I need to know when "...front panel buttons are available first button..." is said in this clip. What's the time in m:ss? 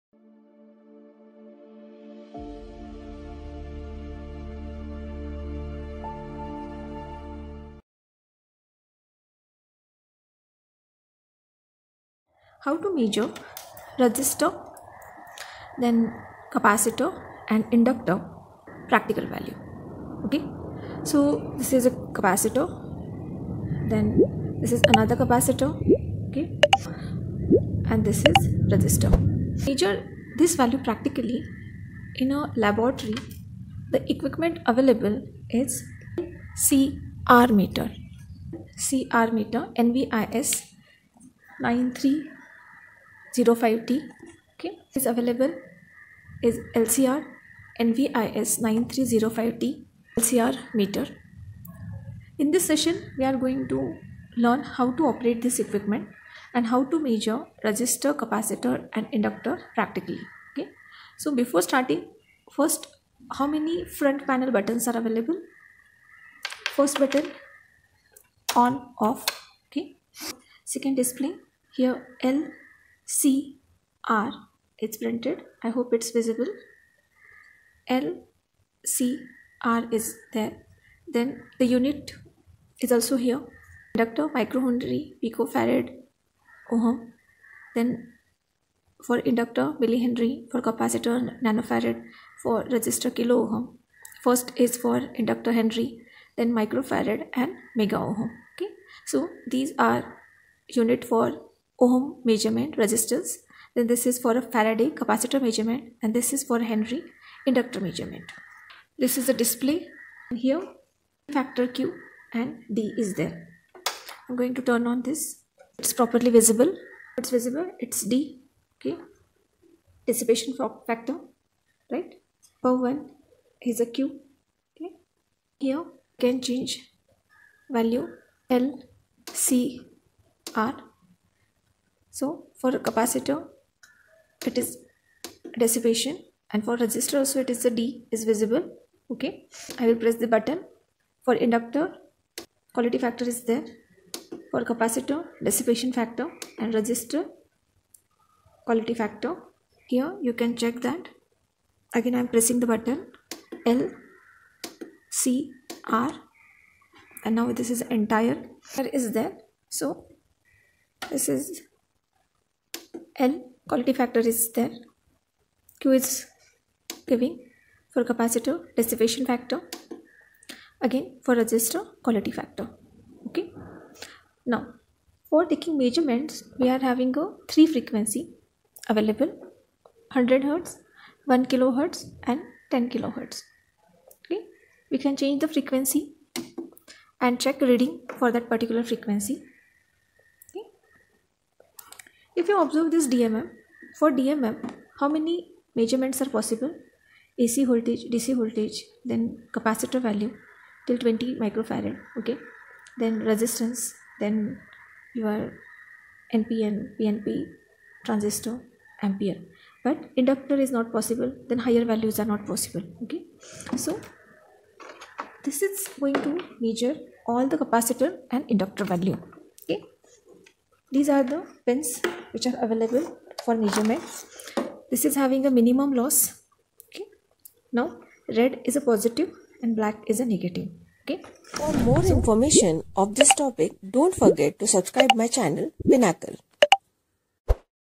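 1:03.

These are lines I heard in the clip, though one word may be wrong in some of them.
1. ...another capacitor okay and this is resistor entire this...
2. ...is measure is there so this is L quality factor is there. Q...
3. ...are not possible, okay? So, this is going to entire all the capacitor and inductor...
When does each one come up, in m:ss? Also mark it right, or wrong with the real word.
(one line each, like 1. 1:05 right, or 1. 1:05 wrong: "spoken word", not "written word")
1. 0:24 wrong: "measure", not "entire"
2. 2:37 wrong: "entire", not "measure"
3. 3:32 wrong: "measure", not "entire".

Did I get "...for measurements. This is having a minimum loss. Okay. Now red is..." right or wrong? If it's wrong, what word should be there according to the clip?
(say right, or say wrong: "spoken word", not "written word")
right.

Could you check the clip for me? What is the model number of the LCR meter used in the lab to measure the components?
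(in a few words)
NVIS 9305T.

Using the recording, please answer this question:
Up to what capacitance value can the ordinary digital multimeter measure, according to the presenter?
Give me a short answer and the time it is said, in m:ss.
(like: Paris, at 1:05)
20 microfarad, at 3:20.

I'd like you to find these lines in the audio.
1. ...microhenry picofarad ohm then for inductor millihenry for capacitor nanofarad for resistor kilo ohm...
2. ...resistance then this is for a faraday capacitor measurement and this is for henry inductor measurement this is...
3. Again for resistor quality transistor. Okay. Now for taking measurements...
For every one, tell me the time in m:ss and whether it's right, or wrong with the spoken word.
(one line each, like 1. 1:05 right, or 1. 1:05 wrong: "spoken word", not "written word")
1. 1:24 right
2. 1:42 right
3. 2:50 wrong: "factor", not "transistor".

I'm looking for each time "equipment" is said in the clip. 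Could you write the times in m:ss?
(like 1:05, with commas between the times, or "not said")
0:34, 0:55.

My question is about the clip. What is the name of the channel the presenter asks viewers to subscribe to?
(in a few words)
Pinnacle.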